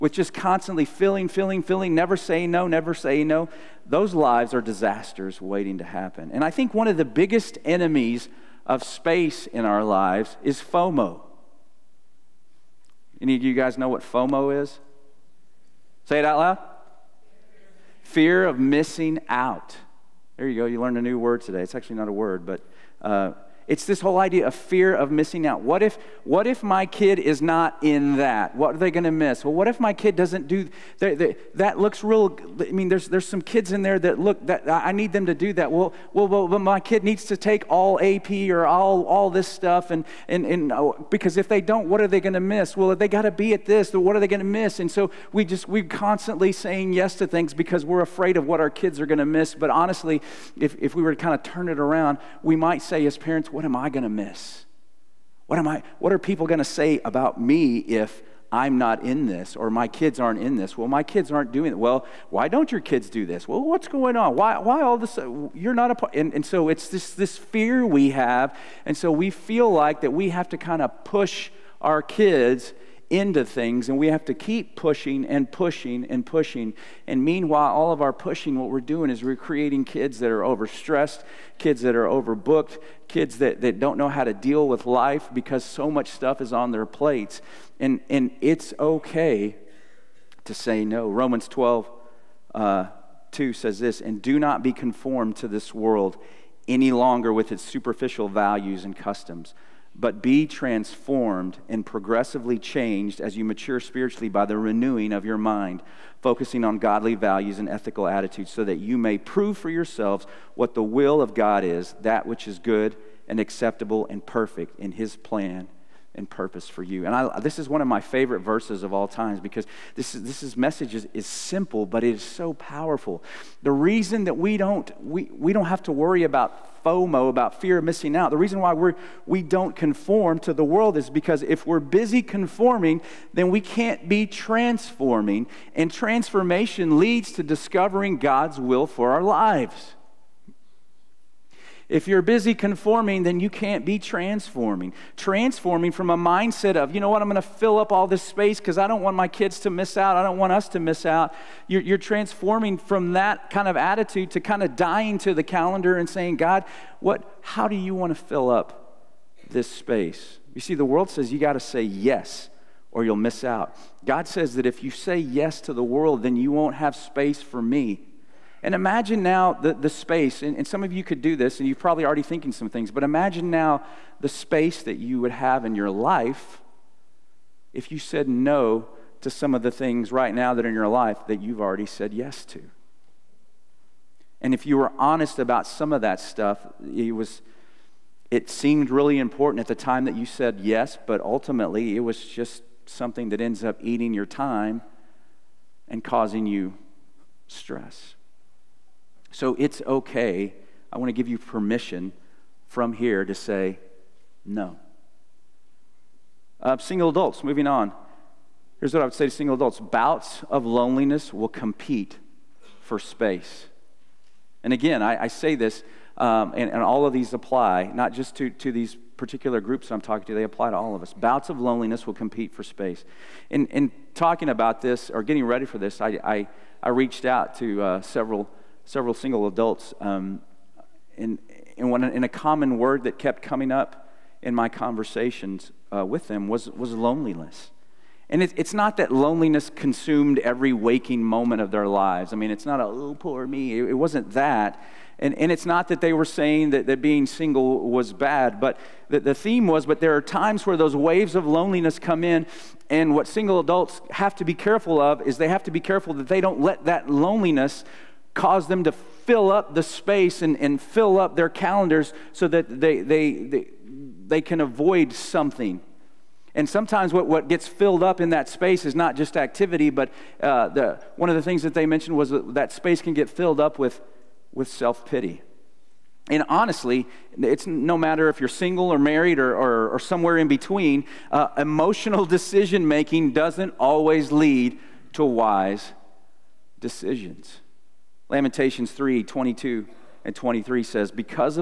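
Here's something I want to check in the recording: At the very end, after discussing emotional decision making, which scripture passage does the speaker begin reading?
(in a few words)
Lamentations 3:22-23.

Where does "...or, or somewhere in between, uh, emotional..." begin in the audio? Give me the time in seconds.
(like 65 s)
279 s.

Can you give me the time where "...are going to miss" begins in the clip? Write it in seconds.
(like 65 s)
48 s.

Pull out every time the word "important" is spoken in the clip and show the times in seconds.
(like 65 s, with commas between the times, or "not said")
189 s.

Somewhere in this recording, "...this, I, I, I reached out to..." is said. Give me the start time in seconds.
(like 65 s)
225 s.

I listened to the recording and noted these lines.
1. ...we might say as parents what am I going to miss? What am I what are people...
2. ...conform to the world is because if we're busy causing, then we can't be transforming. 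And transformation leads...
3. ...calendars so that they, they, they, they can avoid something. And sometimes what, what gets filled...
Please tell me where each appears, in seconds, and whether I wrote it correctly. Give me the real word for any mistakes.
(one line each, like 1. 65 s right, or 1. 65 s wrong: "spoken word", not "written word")
1. 52 s right
2. 129 s wrong: "conforming", not "causing"
3. 261 s right.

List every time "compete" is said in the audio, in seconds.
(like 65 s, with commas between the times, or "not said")
211 s, 222 s.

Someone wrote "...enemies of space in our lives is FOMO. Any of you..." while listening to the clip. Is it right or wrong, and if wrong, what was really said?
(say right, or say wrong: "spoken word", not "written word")
right.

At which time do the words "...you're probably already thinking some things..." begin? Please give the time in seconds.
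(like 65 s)
171 s.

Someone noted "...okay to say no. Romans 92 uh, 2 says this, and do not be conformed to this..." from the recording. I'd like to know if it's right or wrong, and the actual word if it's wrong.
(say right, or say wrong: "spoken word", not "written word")
wrong: "12", not "92".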